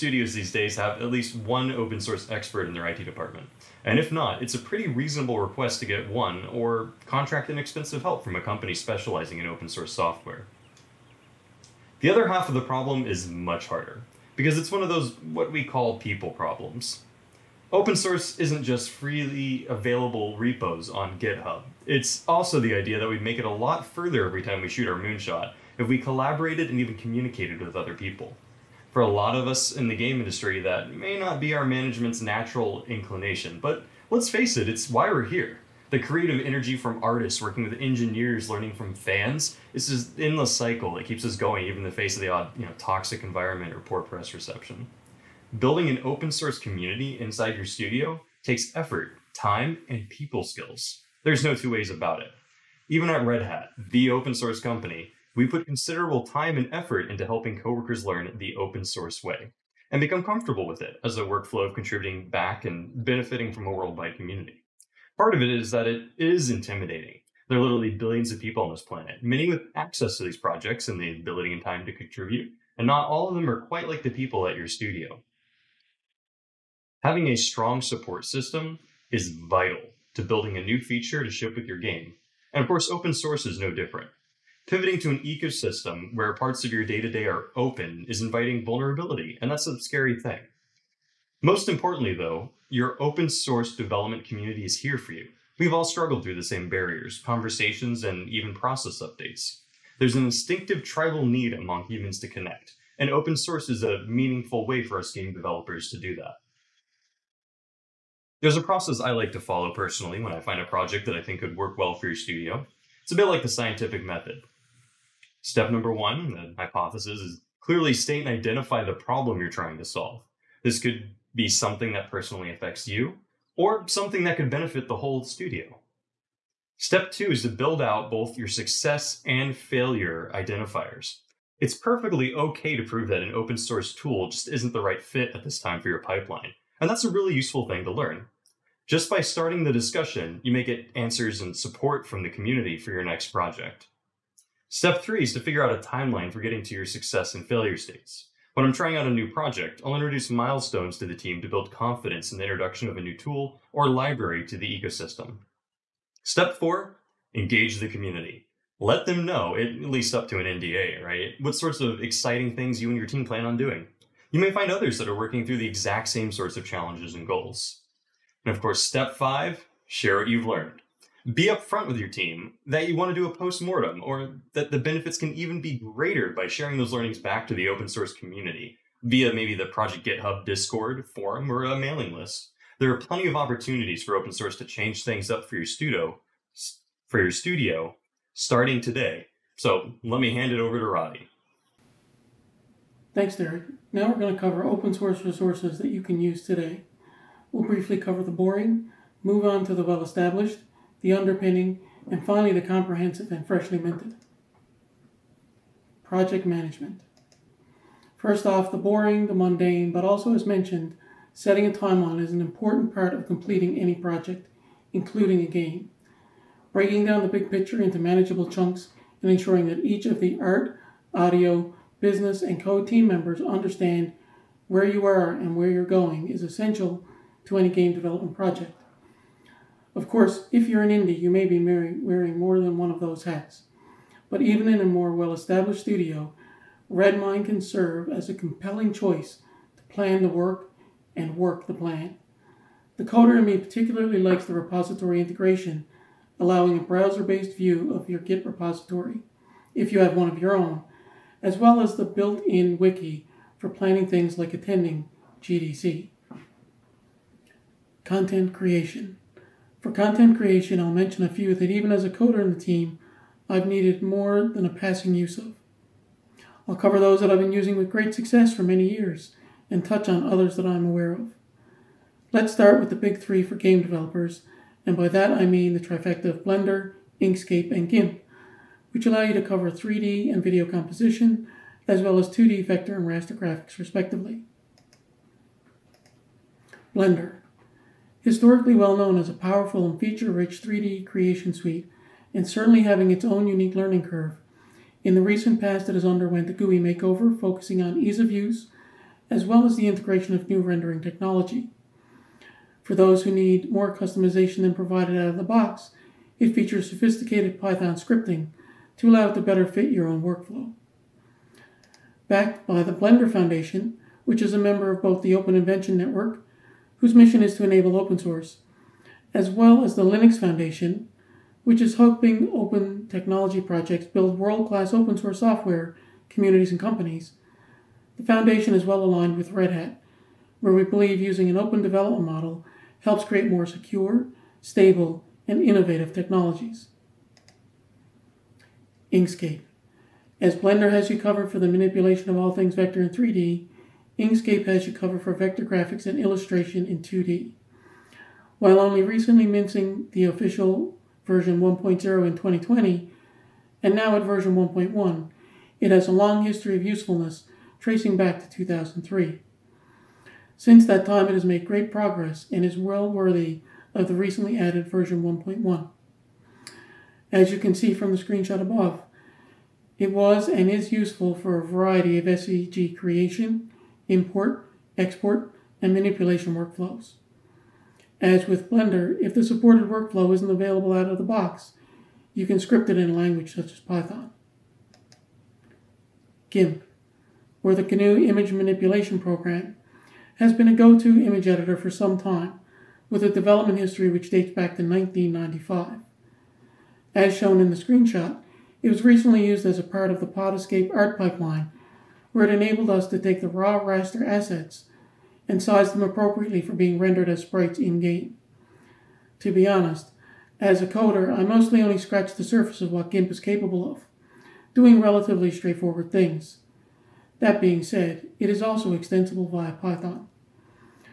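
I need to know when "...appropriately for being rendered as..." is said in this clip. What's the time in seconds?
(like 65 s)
406 s.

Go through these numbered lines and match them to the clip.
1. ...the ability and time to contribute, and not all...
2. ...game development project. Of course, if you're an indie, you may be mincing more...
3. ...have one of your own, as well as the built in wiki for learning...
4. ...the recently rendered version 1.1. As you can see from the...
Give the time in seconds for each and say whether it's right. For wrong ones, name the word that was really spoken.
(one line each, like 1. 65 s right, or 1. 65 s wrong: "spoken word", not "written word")
1. 70 s right
2. 227 s wrong: "wearing", not "mincing"
3. 249 s wrong: "planning", not "learning"
4. 364 s wrong: "added", not "rendered".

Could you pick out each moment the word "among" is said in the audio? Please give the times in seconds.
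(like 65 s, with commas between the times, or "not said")
101 s.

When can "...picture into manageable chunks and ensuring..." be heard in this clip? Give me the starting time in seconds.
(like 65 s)
217 s.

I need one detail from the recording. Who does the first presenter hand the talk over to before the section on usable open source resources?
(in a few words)
Roddy.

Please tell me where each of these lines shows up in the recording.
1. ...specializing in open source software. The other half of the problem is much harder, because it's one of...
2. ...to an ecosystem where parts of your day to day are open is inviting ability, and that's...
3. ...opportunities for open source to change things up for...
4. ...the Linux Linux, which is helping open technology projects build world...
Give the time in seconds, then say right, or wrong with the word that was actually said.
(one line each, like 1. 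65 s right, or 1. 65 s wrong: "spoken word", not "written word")
1. 8 s right
2. 84 s wrong: "vulnerability", not "ability"
3. 183 s right
4. 319 s wrong: "Foundation", not "Linux".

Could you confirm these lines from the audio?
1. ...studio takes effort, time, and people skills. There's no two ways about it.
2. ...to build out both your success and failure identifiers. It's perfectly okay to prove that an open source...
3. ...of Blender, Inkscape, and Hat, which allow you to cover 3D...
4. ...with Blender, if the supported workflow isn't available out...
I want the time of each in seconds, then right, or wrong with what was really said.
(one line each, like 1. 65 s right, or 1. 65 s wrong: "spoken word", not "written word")
1. 47 s right
2. 127 s right
3. 276 s wrong: "GIMP", not "Hat"
4. 378 s right.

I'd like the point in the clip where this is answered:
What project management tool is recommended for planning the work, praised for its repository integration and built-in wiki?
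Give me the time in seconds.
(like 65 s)
236 s.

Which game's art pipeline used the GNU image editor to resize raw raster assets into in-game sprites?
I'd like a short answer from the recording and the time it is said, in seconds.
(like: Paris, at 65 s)
Pod Escape, at 400 s.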